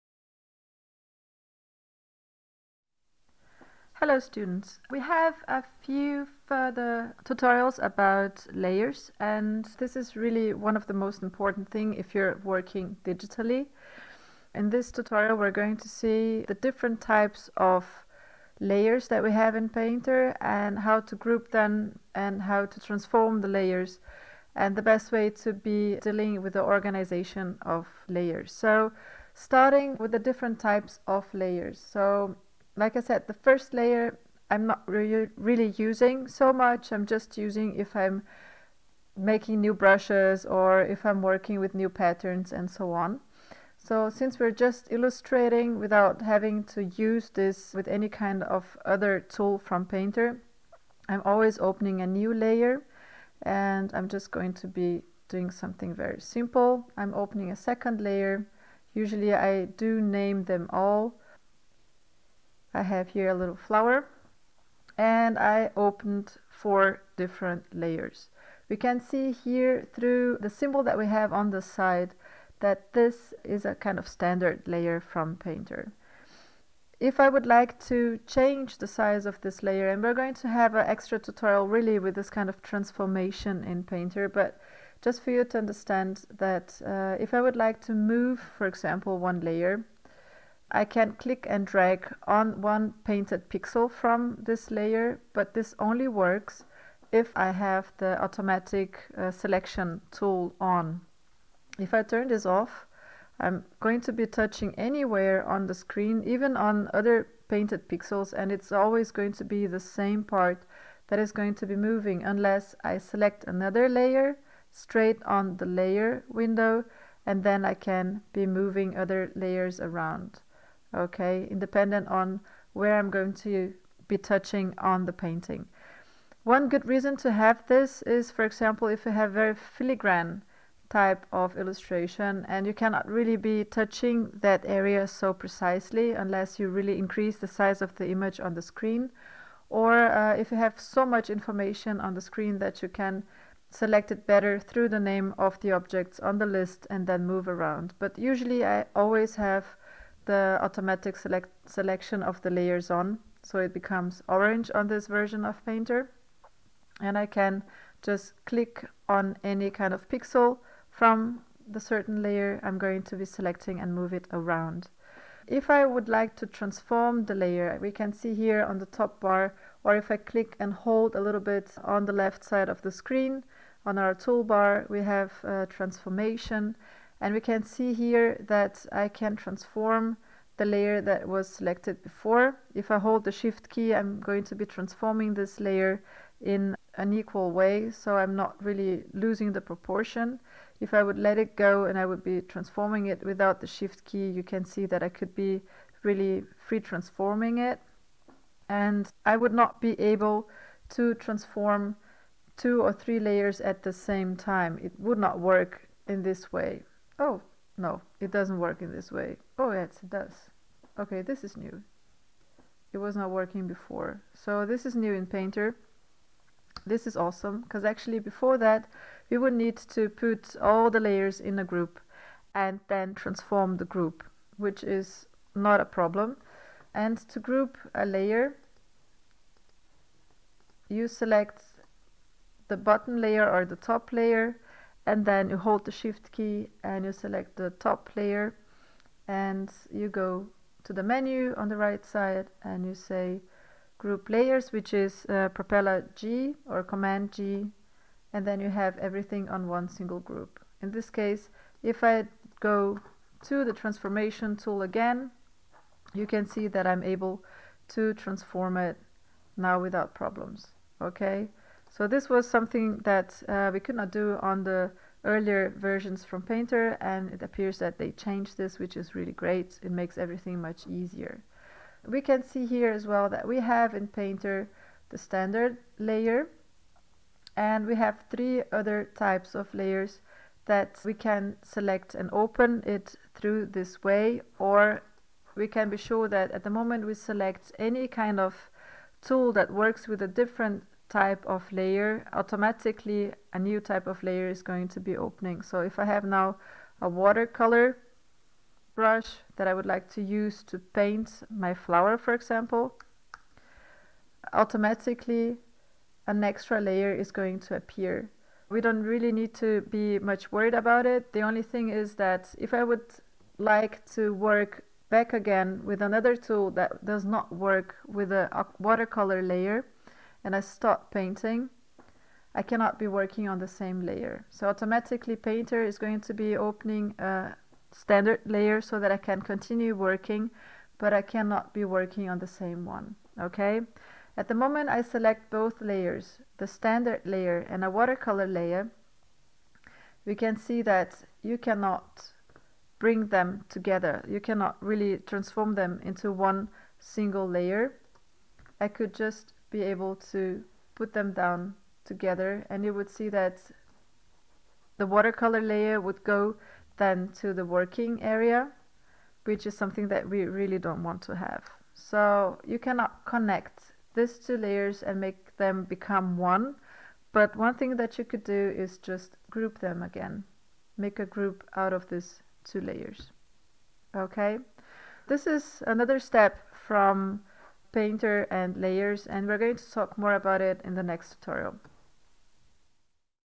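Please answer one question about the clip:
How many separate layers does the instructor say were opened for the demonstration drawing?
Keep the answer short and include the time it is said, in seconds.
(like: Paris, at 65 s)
4, at 66 s.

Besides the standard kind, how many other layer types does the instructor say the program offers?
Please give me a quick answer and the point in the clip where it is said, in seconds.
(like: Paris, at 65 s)
3, at 278 s.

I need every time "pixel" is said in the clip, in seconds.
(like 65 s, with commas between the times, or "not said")
93 s, 107 s, 160 s.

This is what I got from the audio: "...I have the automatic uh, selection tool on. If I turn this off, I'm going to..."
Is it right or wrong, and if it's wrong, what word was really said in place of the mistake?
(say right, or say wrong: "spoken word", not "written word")
right.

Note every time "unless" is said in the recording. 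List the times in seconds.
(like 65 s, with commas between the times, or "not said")
112 s, 136 s.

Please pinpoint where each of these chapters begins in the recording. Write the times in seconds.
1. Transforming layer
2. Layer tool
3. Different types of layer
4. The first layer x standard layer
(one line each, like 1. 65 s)
1. 165 s
2. 86 s
3. 273 s
4. 28 s.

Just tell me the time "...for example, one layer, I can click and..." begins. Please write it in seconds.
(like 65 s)
88 s.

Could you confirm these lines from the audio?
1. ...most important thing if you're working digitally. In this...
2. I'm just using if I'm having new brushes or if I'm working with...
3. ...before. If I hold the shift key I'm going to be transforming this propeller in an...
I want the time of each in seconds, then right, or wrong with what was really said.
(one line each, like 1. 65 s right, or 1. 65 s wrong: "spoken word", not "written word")
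1. 10 s right
2. 36 s wrong: "making", not "having"
3. 182 s wrong: "layer", not "propeller".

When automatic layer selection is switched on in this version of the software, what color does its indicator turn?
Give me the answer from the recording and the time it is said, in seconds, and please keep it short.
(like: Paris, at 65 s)
Orange, at 154 s.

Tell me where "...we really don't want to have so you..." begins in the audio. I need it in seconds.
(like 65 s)
360 s.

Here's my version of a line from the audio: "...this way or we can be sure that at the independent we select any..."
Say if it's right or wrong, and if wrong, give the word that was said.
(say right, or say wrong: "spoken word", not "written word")
wrong: "moment", not "independent".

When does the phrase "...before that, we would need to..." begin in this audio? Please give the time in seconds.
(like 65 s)
218 s.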